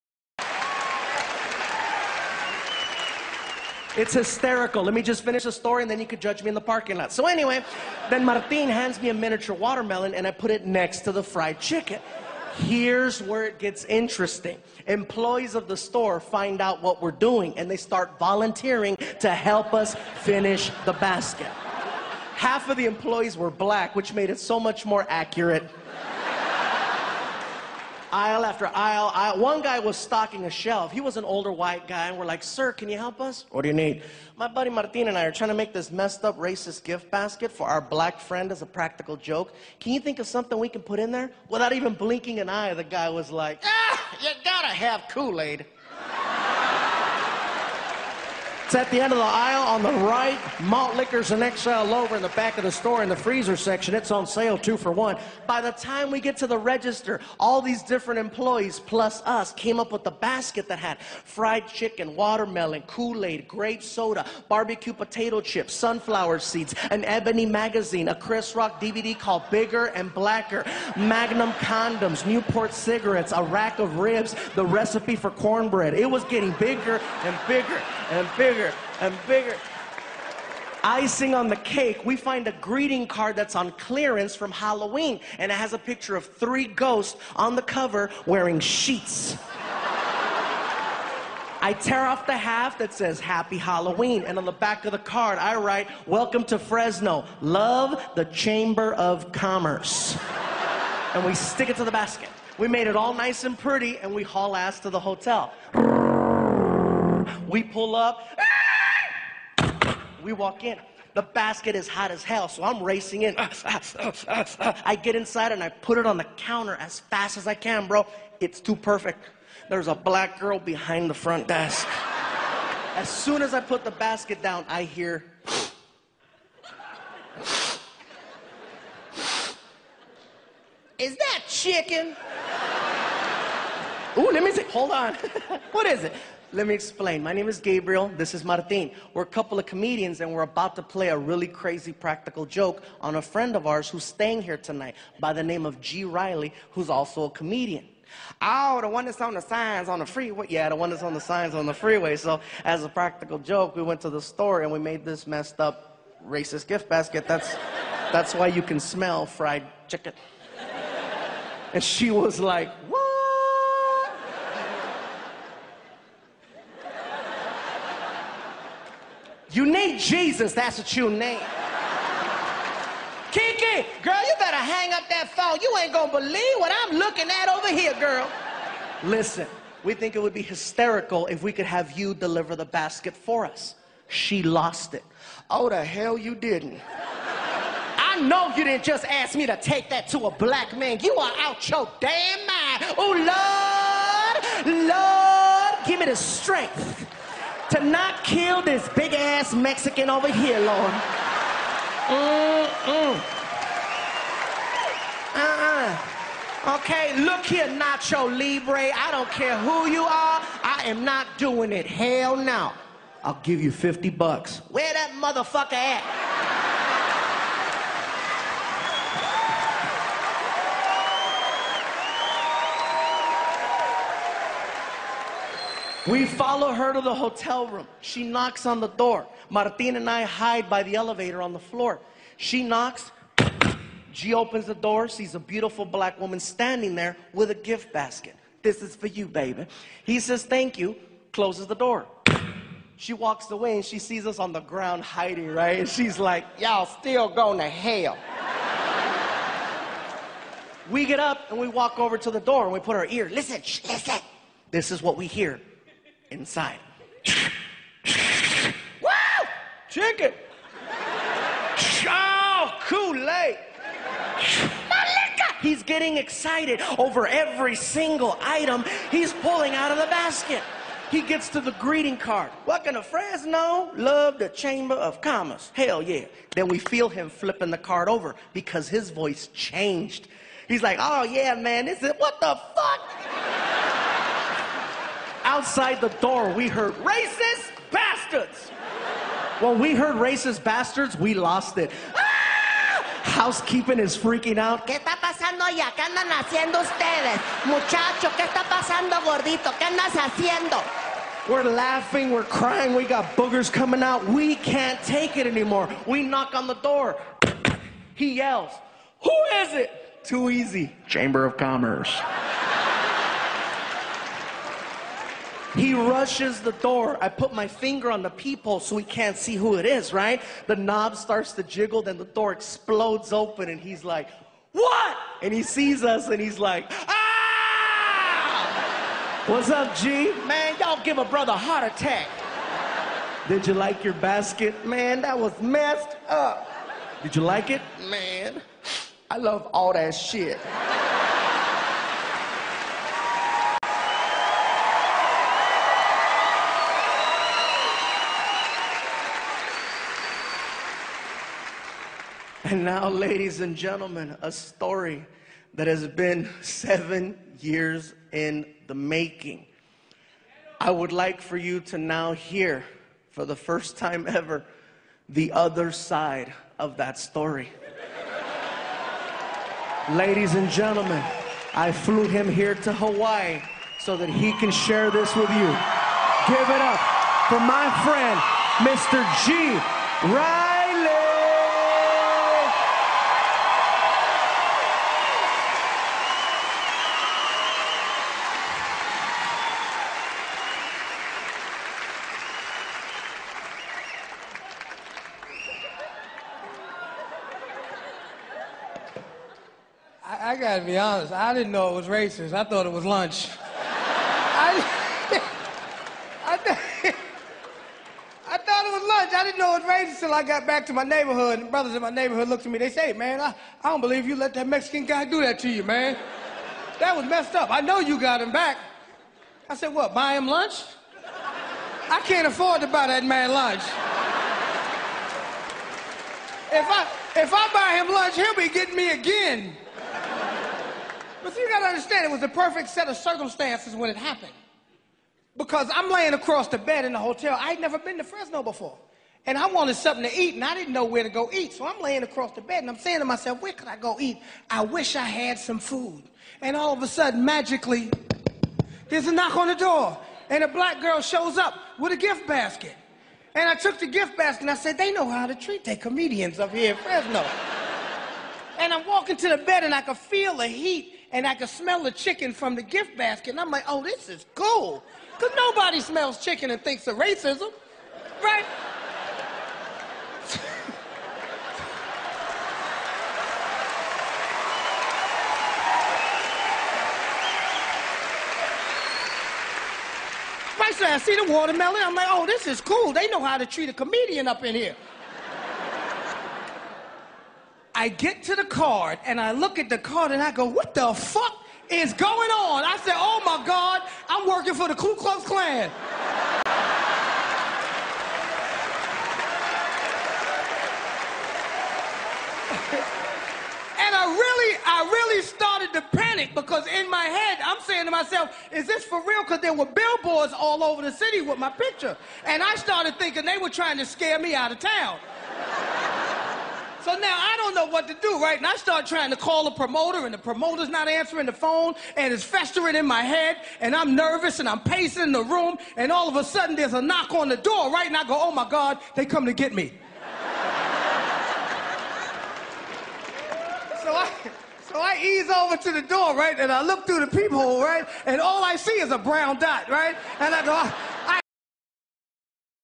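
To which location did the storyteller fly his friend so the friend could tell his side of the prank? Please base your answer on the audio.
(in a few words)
Hawaii.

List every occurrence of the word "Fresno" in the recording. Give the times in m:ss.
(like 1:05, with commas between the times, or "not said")
1:36, 4:33, 7:18, 7:36.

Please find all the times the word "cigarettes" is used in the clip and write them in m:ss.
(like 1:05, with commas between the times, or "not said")
1:12.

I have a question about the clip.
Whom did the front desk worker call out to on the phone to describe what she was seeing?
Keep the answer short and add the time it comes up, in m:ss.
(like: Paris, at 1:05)
Kiki, at 2:53.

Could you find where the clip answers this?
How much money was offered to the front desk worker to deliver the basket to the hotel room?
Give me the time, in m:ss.
3:33.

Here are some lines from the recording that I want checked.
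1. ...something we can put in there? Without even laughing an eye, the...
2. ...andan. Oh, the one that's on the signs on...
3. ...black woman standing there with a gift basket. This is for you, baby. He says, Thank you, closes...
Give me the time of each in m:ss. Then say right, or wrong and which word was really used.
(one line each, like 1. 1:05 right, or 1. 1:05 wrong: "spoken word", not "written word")
1. 0:40 wrong: "blinking", not "laughing"
2. 2:27 wrong: "comedian", not "andan"
3. 3:55 right.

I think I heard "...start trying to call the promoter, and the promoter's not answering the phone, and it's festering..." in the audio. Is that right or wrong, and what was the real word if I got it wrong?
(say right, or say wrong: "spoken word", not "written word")
right.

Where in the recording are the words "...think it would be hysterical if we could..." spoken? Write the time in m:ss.
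2:59.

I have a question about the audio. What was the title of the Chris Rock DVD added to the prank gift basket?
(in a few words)
Bigger and Blacker.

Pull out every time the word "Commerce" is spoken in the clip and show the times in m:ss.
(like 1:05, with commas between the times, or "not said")
1:39, 4:35, 5:11.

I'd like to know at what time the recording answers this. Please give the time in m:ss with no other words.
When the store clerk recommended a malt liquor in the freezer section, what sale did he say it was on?
0:54.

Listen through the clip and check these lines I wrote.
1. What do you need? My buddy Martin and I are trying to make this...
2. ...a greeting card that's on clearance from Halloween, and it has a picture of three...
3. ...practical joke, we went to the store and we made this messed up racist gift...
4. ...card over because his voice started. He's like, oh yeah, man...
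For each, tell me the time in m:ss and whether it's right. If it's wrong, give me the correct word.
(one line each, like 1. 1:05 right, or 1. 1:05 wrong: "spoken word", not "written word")
1. 0:33 right
2. 1:22 right
3. 2:32 right
4. 4:37 wrong: "changed", not "started".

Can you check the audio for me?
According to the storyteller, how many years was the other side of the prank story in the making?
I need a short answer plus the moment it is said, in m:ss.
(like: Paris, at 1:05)
7, at 5:56.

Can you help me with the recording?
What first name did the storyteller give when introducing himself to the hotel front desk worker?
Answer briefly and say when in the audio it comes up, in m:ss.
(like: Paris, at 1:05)
Gabriel, at 2:17.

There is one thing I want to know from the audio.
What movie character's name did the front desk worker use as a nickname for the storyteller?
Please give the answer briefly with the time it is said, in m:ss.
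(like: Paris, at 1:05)
Nacho Libre, at 3:27.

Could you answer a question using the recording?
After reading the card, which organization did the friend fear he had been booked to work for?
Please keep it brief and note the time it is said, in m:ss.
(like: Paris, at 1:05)
Ku Klux Klan, at 8:14.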